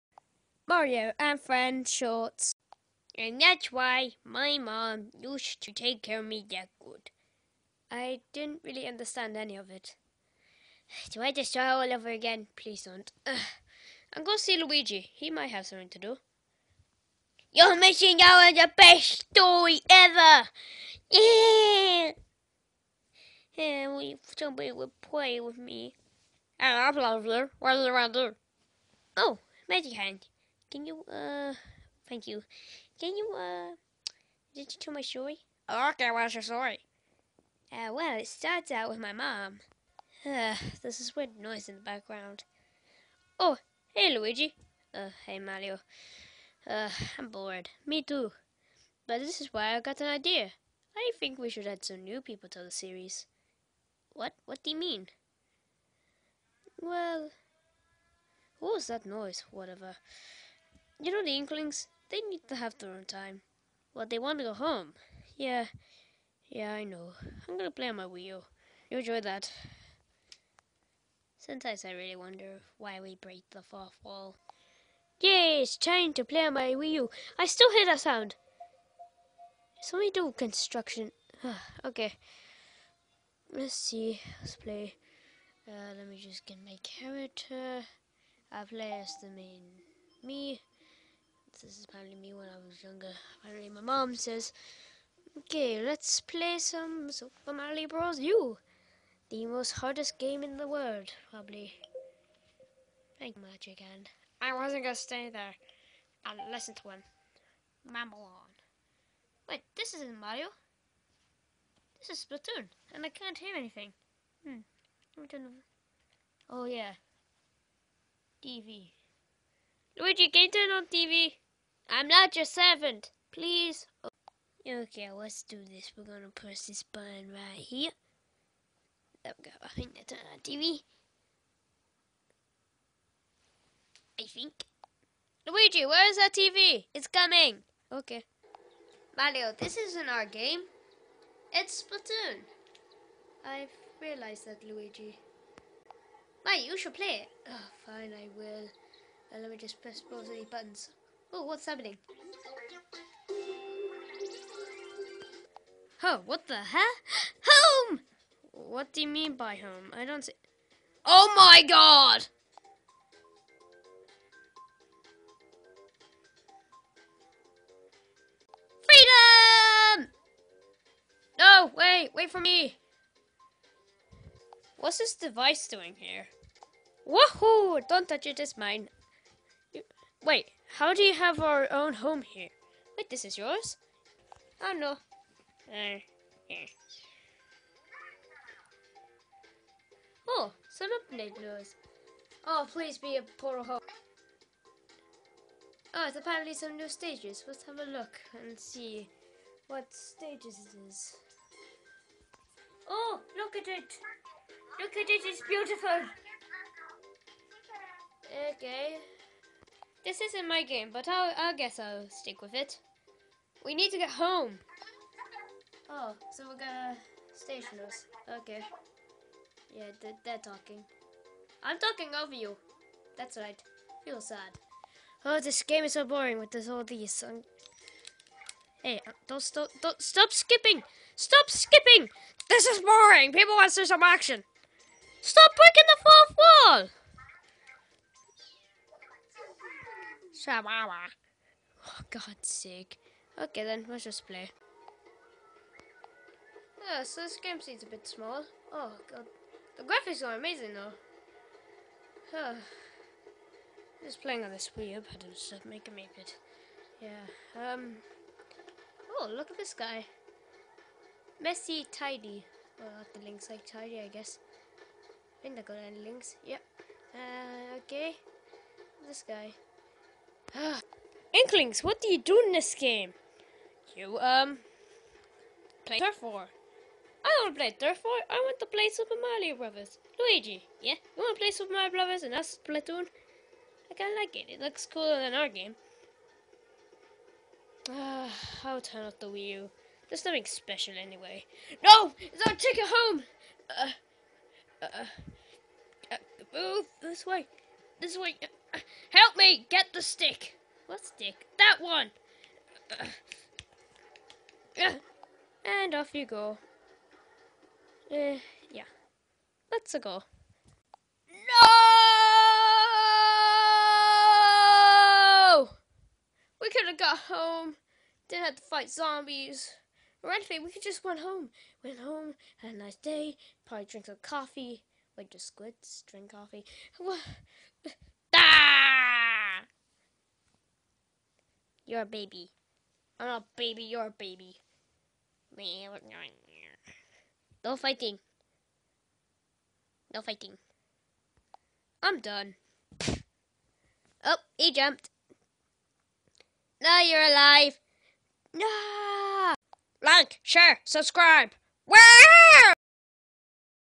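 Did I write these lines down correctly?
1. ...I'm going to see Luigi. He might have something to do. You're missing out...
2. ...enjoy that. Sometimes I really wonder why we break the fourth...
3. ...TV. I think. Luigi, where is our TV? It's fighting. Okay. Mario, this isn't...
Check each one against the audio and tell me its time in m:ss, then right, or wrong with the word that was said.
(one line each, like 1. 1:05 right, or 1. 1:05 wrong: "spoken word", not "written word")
1. 0:14 right
2. 1:08 right
3. 2:10 wrong: "coming", not "fighting".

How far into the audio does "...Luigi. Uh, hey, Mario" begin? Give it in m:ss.
0:44.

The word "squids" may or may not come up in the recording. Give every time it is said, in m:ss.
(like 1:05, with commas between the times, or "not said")
5:25.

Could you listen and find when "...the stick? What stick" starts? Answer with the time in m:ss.
5:00.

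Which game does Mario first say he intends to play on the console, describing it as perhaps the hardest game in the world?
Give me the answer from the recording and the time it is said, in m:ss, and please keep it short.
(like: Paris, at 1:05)
Super Mario Bros. U, at 1:37.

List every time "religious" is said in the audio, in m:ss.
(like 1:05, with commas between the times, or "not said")
not said.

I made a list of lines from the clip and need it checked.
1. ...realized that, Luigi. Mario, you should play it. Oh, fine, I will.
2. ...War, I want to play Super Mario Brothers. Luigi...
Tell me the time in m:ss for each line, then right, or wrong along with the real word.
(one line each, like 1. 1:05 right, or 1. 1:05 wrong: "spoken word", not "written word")
1. 2:24 right
2. 4:38 right.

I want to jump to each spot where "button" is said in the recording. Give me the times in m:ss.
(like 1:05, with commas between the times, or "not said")
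2:06, 2:30.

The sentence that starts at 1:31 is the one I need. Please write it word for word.
This is apparently me when I was younger.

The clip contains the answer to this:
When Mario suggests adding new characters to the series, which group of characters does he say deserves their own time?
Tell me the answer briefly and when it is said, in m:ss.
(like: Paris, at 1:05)
The Inklings, at 1:01.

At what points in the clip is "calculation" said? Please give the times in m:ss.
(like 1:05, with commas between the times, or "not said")
not said.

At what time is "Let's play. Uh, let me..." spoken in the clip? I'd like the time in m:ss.
1:24.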